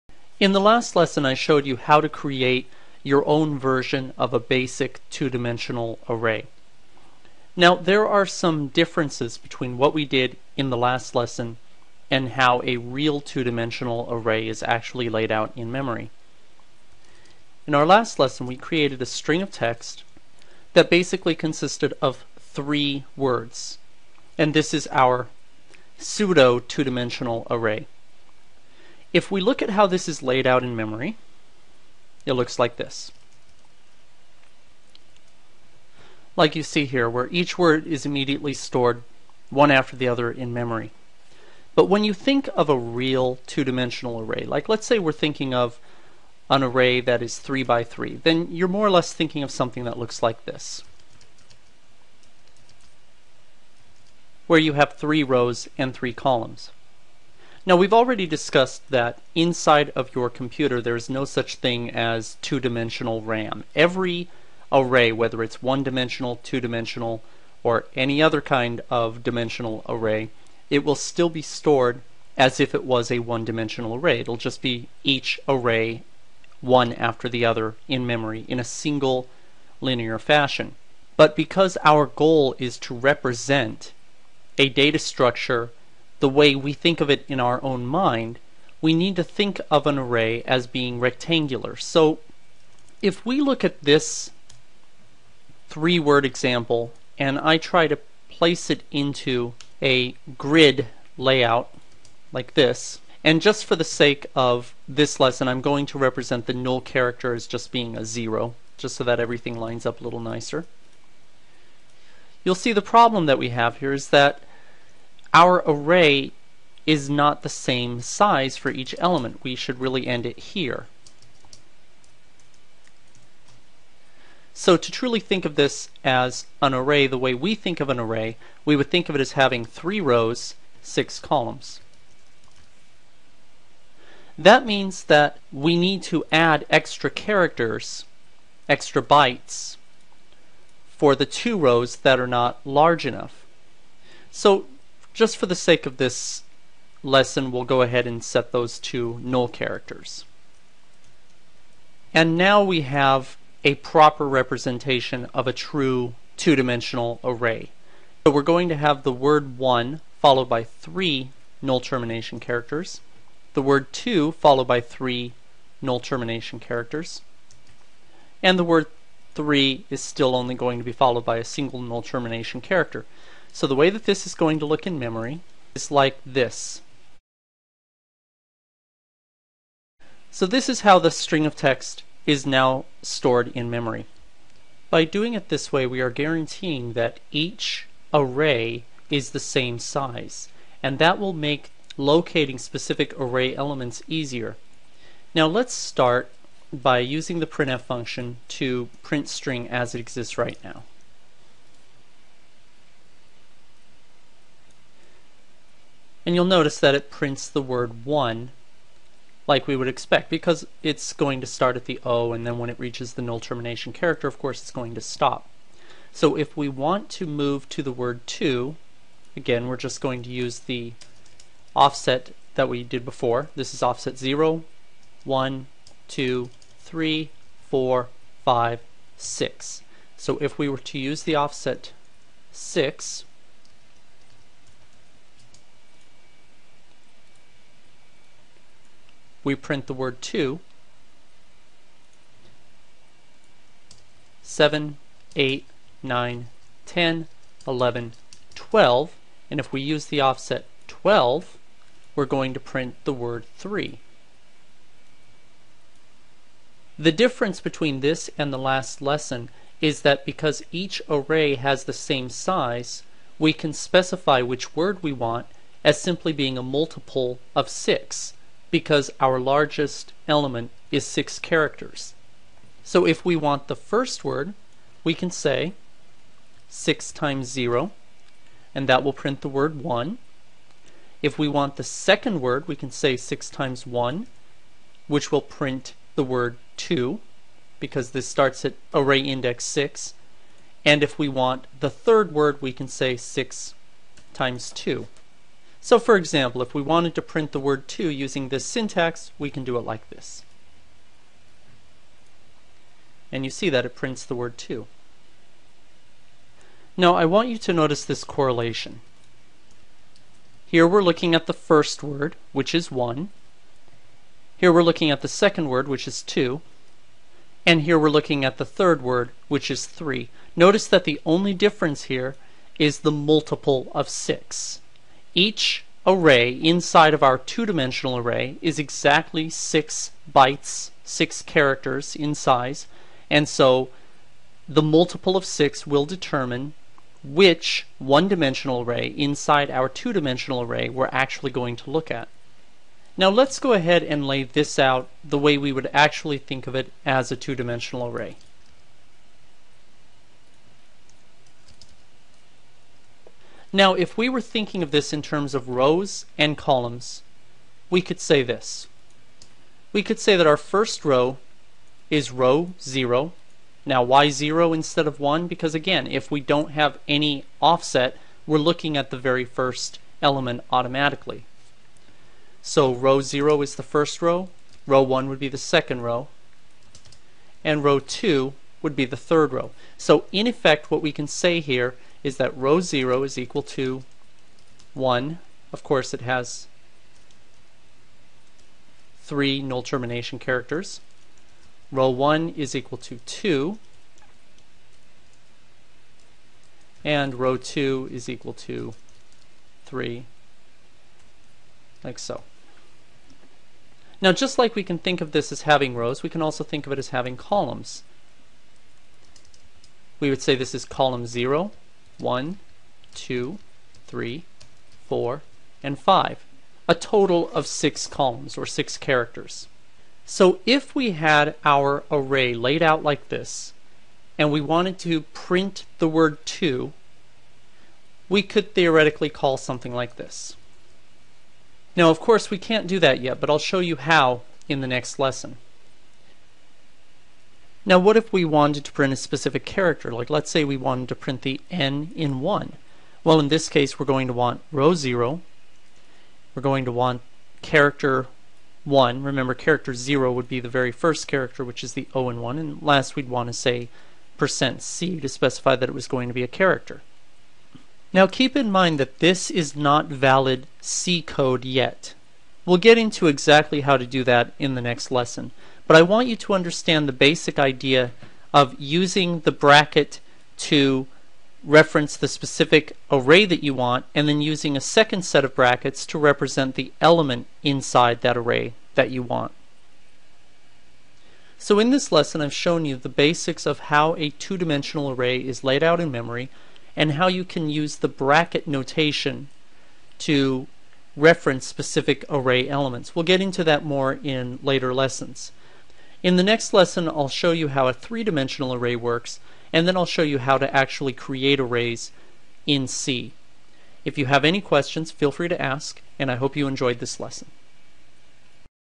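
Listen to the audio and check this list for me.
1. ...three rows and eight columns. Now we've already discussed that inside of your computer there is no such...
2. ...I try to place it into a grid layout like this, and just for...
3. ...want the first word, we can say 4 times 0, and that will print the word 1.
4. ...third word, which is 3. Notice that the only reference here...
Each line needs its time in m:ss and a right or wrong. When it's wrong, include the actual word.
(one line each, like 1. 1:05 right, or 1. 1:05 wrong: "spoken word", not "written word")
1. 0:54 wrong: "three", not "eight"
2. 1:37 right
3. 4:33 wrong: "6", not "4"
4. 5:18 wrong: "difference", not "reference".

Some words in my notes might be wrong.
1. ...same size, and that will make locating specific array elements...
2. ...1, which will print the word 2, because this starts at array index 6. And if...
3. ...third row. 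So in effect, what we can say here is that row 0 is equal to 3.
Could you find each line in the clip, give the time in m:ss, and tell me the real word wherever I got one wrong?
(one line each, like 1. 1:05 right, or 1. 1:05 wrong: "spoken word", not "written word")
1. 3:09 right
2. 4:43 right
3. 6:19 wrong: "1", not "3".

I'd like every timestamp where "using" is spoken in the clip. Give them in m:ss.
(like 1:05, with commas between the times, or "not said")
3:16, 4:58, 7:48, 7:54.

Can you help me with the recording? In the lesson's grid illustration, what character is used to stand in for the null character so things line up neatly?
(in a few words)
0.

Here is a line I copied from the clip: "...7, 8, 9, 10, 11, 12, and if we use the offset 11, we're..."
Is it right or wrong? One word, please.
wrong.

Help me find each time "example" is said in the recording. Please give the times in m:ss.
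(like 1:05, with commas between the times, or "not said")
1:36, 4:56.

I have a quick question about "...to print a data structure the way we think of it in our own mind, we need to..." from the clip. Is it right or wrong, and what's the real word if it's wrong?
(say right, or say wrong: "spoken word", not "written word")
wrong: "represent", not "print".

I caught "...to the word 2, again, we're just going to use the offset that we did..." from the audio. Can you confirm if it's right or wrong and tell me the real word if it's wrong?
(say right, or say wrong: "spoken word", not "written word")
right.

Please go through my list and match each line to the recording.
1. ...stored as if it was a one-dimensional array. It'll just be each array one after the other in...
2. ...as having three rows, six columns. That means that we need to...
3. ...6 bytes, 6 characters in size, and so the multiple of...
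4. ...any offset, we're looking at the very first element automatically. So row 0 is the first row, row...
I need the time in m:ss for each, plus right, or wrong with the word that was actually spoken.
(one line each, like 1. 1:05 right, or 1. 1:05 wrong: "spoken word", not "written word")
1. 1:11 right
2. 2:09 right
3. 5:29 right
4. 6:07 right.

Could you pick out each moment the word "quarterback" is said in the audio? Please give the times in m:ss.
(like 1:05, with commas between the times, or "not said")
not said.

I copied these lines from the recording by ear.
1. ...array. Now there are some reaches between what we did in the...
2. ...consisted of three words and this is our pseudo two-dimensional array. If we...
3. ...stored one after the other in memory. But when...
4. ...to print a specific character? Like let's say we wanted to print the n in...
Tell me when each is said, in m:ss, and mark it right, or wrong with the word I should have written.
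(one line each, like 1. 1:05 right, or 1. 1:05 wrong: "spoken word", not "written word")
1. 0:06 wrong: "differences", not "reaches"
2. 0:21 right
3. 0:38 right
4. 7:18 right.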